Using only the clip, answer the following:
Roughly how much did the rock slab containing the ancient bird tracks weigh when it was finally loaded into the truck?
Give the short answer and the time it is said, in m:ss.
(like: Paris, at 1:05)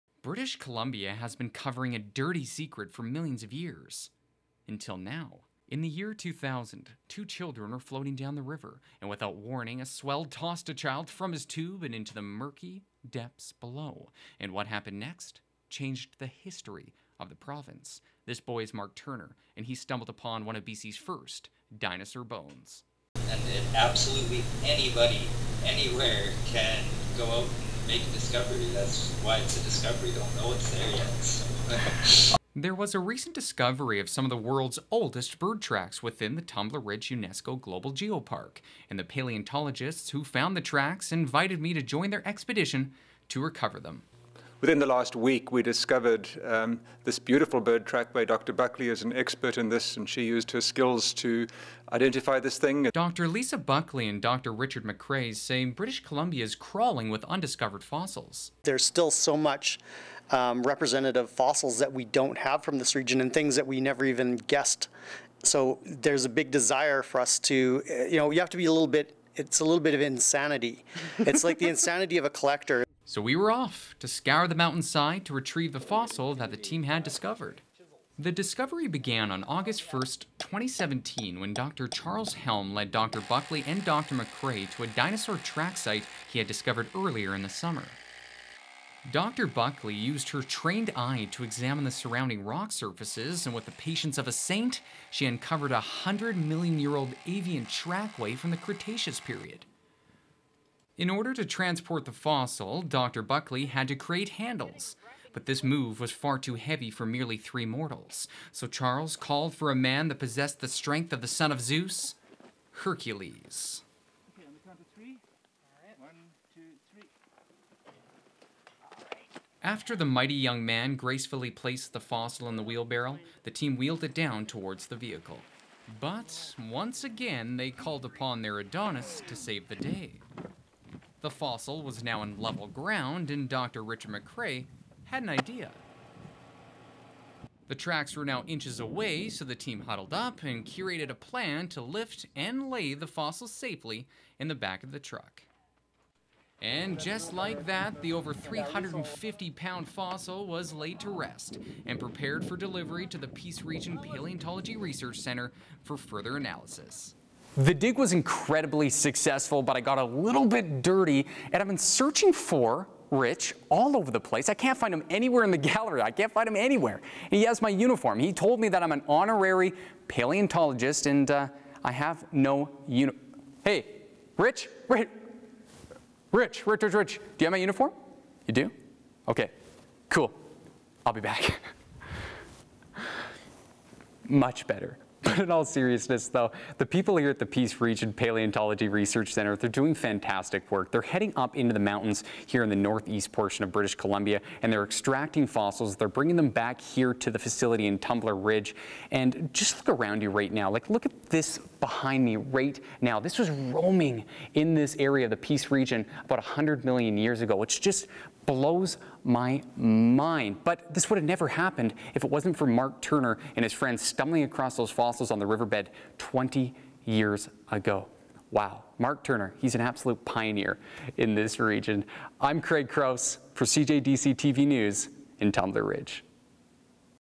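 Over 350 pounds, at 2:28.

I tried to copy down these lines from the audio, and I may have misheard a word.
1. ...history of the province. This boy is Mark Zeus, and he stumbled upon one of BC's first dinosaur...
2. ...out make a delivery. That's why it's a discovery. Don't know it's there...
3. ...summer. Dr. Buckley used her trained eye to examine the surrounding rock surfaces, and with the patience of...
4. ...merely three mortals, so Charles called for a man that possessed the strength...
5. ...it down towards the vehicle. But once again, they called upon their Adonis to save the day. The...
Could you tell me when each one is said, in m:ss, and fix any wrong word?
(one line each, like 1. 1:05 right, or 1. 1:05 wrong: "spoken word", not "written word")
1. 0:16 wrong: "Turner", not "Zeus"
2. 0:27 wrong: "discovery", not "delivery"
3. 1:27 right
4. 1:47 right
5. 2:04 right.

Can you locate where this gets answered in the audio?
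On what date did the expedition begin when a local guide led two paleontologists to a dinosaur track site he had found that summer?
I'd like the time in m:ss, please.
1:19.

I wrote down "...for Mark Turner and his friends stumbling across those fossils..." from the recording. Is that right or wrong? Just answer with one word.
right.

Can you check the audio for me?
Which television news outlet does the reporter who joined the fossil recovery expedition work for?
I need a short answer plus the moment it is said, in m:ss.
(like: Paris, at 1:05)
CJDC TV News, at 3:43.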